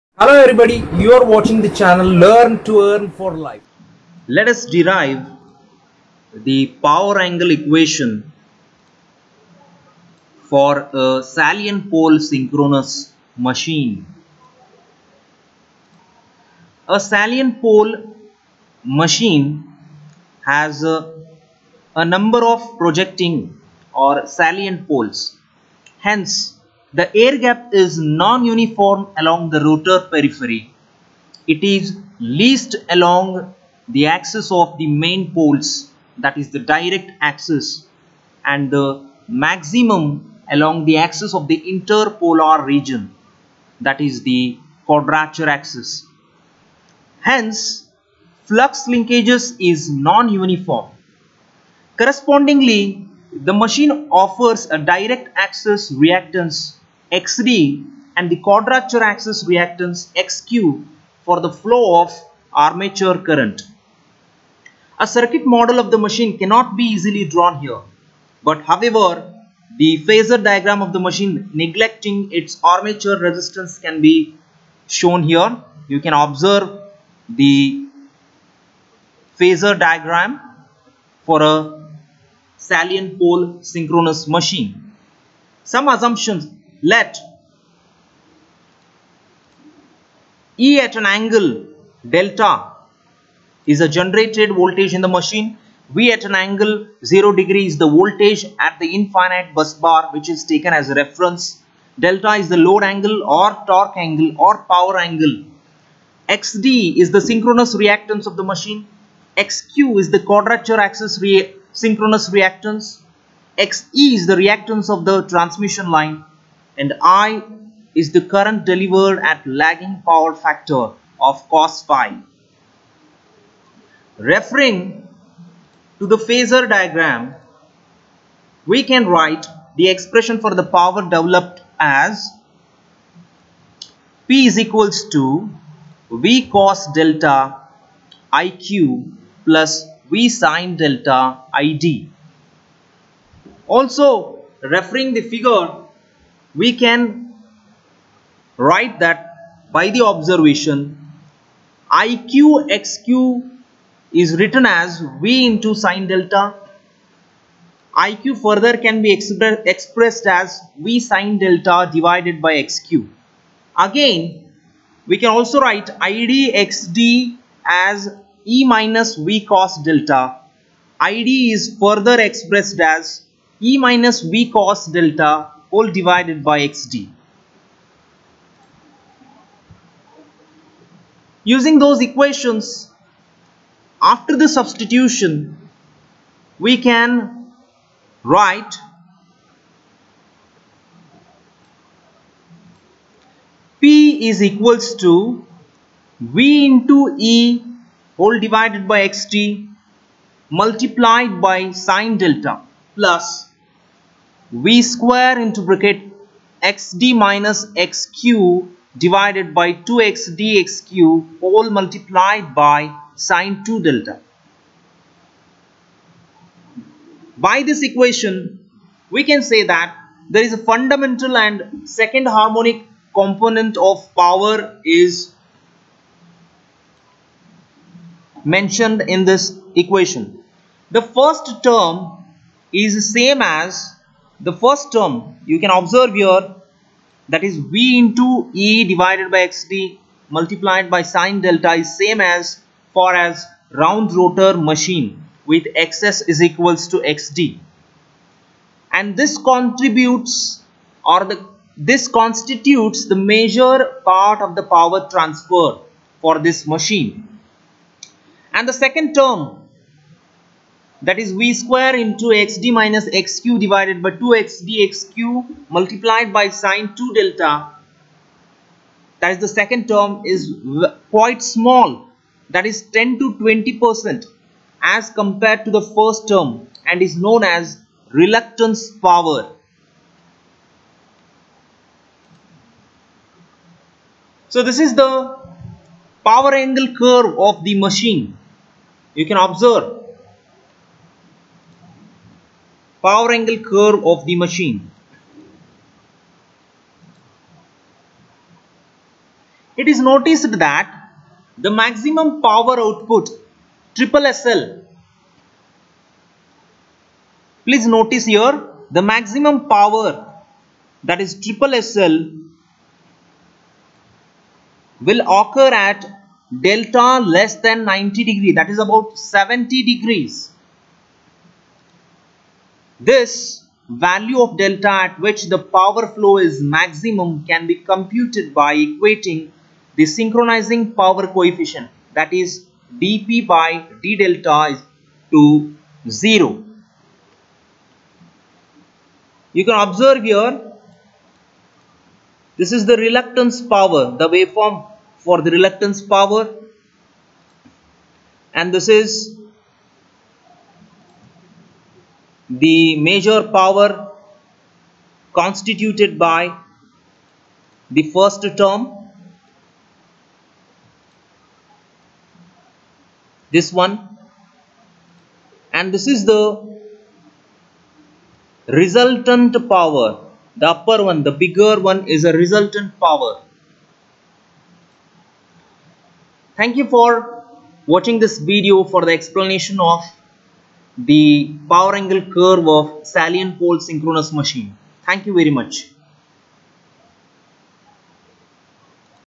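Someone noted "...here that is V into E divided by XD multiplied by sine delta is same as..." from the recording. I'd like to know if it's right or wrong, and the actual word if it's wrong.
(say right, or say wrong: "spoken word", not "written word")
right.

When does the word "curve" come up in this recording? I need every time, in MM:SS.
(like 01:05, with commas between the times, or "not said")
04:47, 04:53, 06:22.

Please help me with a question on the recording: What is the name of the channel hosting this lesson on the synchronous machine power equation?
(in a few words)
Learn to Earn for Life.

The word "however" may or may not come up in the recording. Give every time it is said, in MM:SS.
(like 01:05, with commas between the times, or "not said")
01:08.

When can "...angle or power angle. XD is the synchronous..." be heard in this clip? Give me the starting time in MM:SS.
01:43.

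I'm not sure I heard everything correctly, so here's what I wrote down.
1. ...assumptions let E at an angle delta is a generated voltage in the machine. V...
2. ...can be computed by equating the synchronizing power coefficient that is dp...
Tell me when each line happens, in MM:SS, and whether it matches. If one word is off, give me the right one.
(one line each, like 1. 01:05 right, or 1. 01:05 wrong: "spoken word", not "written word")
1. 01:25 right
2. 05:27 right.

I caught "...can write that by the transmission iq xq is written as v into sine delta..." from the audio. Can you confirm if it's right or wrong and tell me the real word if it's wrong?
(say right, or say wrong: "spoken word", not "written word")
wrong: "observation", not "transmission".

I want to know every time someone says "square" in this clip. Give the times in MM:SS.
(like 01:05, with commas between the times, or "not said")
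03:24, 04:21.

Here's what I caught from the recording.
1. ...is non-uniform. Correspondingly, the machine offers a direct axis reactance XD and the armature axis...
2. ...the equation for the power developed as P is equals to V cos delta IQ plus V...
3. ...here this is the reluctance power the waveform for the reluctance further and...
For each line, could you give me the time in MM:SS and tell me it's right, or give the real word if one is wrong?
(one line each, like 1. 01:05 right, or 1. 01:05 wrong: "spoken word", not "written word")
1. 00:49 wrong: "quadrature", not "armature"
2. 02:09 wrong: "expression", not "equation"
3. 05:40 wrong: "power", not "further".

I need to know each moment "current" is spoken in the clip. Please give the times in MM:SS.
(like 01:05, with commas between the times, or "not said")
01:03, 01:58.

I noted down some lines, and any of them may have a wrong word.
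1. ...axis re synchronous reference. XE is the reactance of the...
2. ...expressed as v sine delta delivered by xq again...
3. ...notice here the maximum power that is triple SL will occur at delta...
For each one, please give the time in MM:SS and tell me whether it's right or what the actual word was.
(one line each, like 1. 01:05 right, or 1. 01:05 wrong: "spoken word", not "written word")
1. 01:50 wrong: "reactance", not "reference"
2. 02:39 wrong: "divided", not "delivered"
3. 05:07 right.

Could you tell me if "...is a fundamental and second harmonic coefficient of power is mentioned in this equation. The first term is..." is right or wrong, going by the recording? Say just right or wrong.
wrong.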